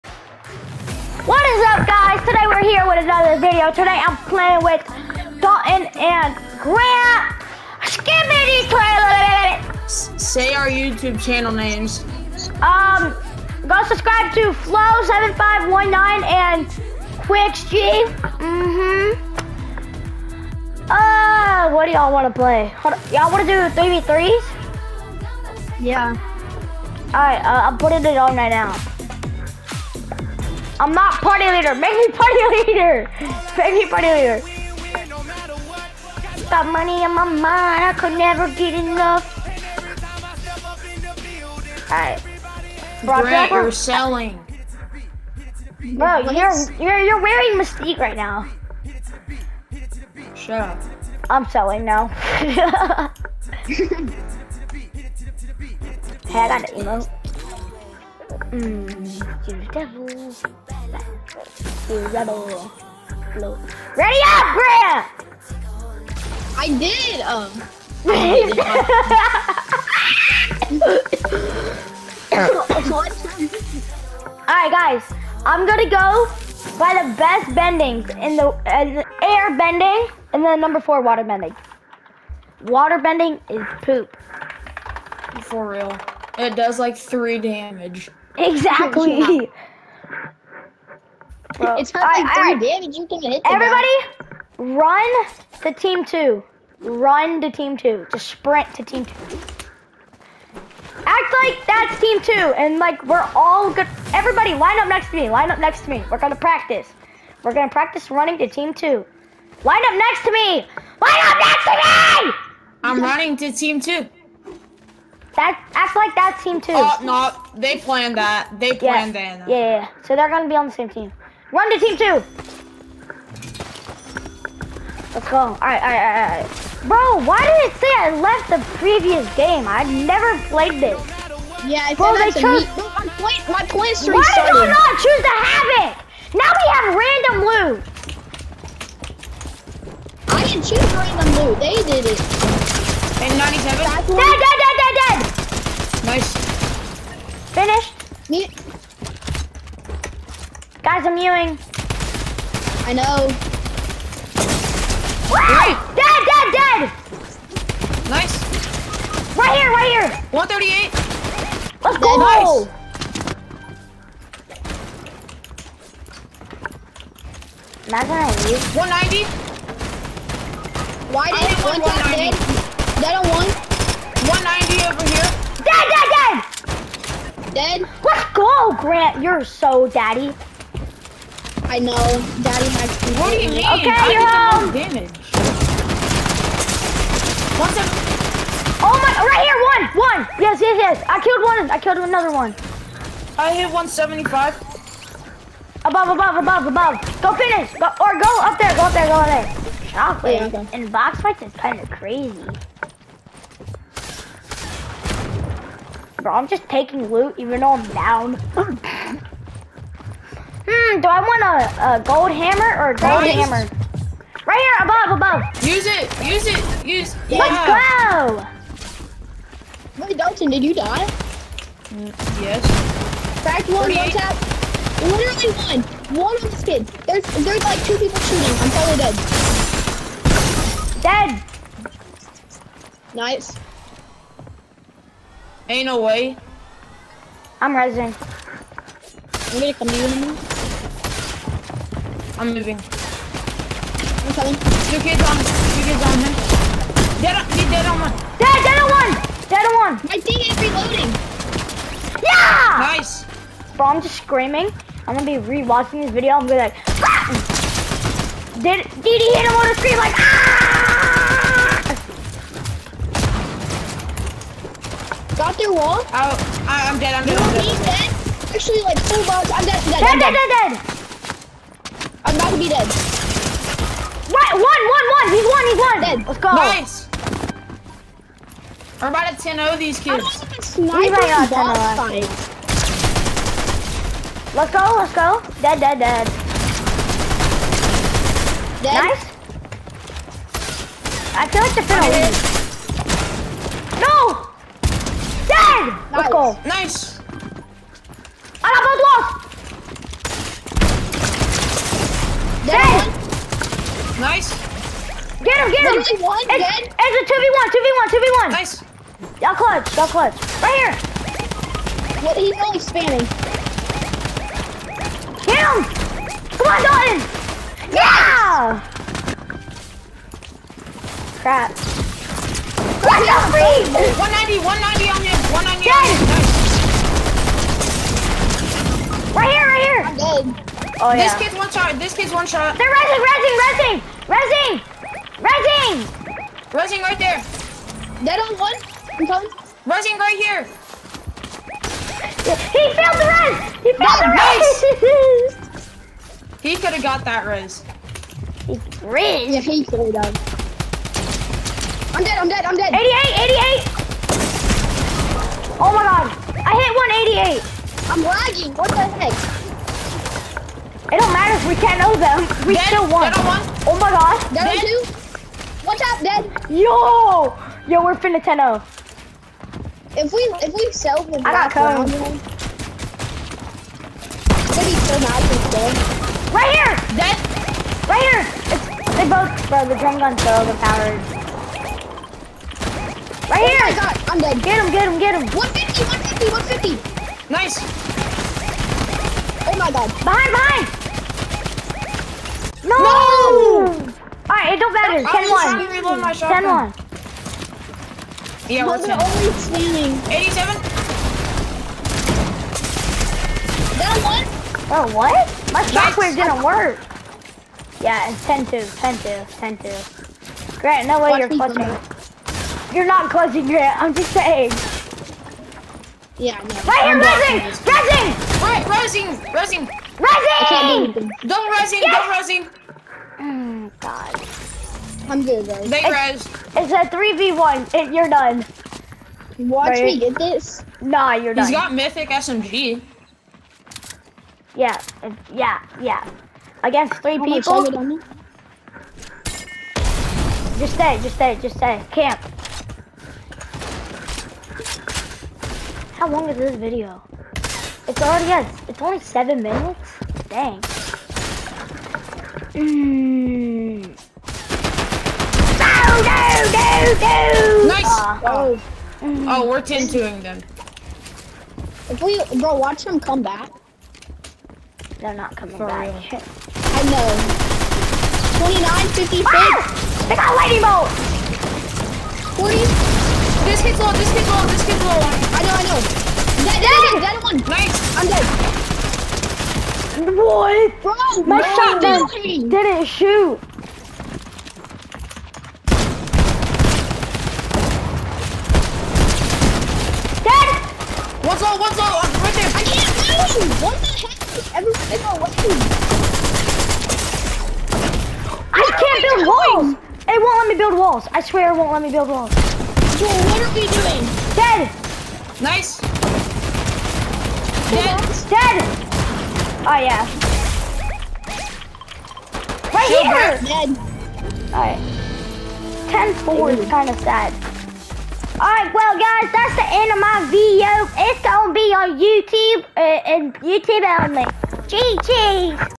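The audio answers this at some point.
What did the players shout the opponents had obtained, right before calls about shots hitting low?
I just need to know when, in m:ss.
7:50.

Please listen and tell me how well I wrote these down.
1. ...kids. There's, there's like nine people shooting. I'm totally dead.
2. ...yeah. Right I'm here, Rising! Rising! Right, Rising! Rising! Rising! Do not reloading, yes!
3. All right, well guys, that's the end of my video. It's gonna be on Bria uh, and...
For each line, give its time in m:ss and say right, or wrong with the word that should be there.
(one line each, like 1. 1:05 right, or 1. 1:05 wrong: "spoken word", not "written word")
1. 3:46 wrong: "two", not "nine"
2. 6:56 wrong: "rising", not "reloading"
3. 8:38 wrong: "YouTube", not "Bria".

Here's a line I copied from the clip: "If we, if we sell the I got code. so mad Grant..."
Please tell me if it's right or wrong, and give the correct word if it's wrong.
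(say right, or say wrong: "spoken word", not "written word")
wrong: "Right", not "Grant".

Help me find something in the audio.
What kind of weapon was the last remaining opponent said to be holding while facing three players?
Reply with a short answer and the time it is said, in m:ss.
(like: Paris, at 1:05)
Mythic SMG, at 7:11.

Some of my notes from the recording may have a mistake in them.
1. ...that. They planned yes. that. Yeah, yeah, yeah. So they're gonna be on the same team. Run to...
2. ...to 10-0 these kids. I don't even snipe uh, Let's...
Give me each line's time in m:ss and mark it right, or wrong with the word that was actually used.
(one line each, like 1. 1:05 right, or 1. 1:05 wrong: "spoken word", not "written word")
1. 1:58 right
2. 4:39 right.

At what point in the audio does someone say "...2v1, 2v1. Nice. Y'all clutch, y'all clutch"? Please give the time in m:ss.
5:07.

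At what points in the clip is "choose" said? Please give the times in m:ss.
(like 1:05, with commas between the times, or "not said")
2:14, 2:20.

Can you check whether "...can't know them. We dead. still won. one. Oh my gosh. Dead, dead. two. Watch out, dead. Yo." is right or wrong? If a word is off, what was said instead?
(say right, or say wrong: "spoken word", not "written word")
right.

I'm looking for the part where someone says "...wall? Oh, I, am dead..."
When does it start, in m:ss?
4:25.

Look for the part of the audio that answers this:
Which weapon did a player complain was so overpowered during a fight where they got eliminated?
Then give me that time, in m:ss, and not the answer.
6:19.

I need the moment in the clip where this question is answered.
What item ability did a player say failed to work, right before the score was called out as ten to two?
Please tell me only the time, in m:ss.
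6:45.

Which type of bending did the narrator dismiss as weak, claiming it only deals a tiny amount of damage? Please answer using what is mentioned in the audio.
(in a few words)
Water bending.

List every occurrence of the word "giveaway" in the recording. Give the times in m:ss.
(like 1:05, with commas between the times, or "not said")
not said.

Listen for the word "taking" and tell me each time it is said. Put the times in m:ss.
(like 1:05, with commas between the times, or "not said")
3:26.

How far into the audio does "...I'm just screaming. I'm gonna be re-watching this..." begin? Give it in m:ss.
4:13.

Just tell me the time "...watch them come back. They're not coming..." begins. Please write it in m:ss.
7:42.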